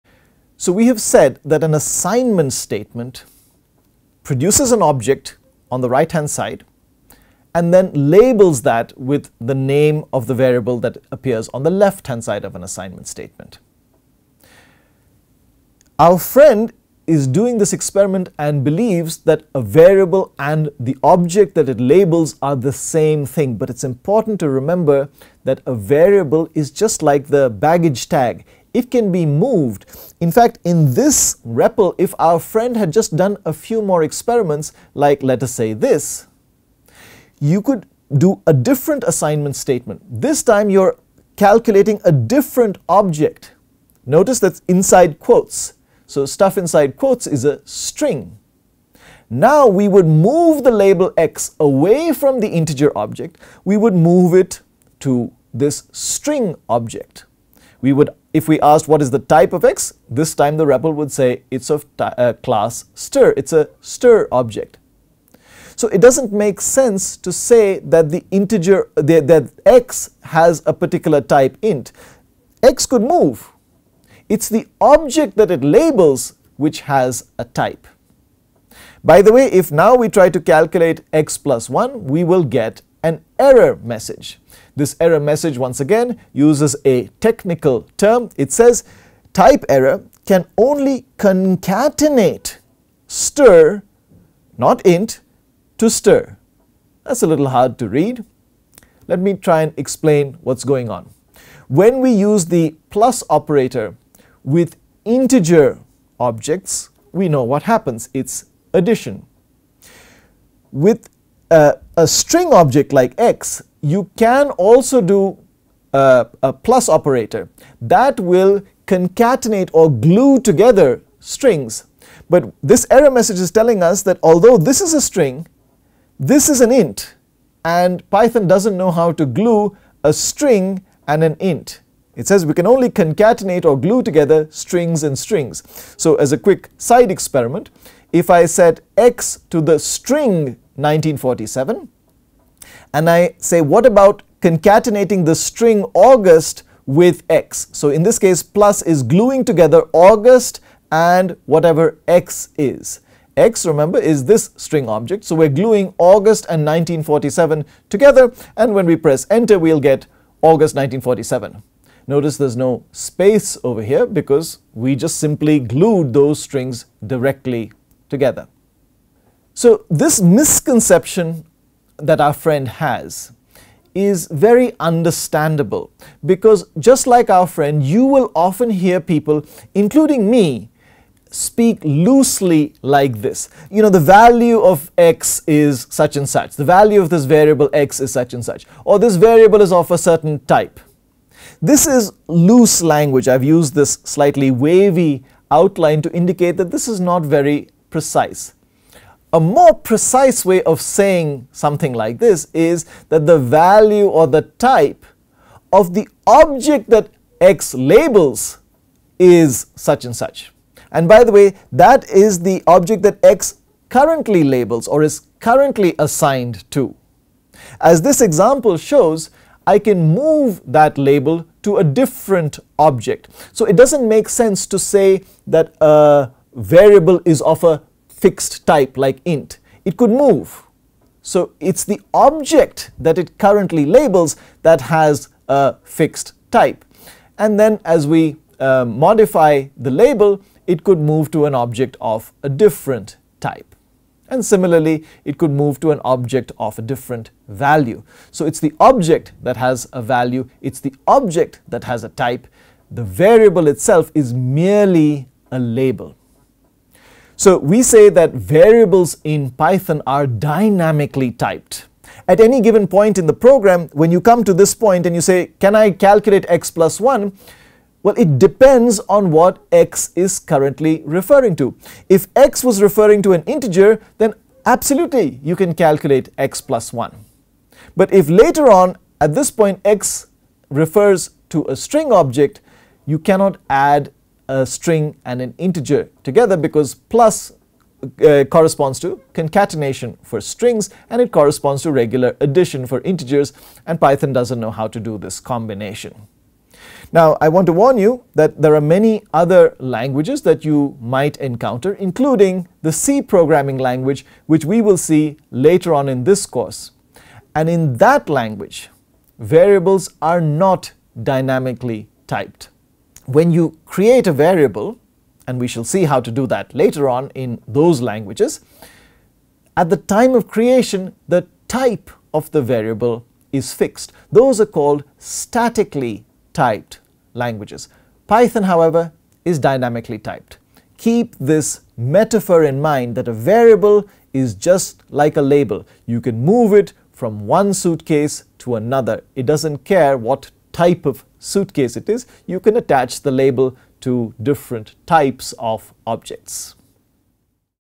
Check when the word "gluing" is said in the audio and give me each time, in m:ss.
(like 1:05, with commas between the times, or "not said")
2:29, 2:35.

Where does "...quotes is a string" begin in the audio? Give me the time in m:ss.
0:46.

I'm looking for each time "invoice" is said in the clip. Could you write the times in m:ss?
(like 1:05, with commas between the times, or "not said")
not said.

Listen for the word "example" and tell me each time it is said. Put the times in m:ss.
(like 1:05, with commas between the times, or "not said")
3:38.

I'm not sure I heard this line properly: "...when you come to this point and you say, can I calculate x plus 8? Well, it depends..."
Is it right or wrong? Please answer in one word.
wrong.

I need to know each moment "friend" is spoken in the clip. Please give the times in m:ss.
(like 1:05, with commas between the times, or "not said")
0:16, 0:32, 2:52, 2:57.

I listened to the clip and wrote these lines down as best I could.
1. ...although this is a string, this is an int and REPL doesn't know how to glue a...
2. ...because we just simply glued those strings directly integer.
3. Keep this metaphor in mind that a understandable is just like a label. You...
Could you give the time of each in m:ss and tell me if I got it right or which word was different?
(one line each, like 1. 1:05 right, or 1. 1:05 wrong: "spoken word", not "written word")
1. 2:04 wrong: "Python", not "REPL"
2. 2:44 wrong: "together", not "integer"
3. 5:30 wrong: "variable", not "understandable".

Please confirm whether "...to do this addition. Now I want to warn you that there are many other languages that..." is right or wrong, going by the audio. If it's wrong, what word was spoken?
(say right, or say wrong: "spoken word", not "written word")
wrong: "combination", not "addition".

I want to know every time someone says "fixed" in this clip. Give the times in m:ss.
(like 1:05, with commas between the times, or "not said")
3:48, 3:55, 5:23.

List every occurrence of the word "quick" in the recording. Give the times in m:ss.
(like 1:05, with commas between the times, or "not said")
2:16.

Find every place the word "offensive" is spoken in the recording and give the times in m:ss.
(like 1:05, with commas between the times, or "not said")
not said.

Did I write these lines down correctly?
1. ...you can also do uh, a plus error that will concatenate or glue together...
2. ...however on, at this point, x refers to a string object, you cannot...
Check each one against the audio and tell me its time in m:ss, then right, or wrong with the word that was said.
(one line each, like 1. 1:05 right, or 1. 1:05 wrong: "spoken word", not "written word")
1. 1:53 wrong: "operator", not "error"
2. 4:38 wrong: "later", not "however".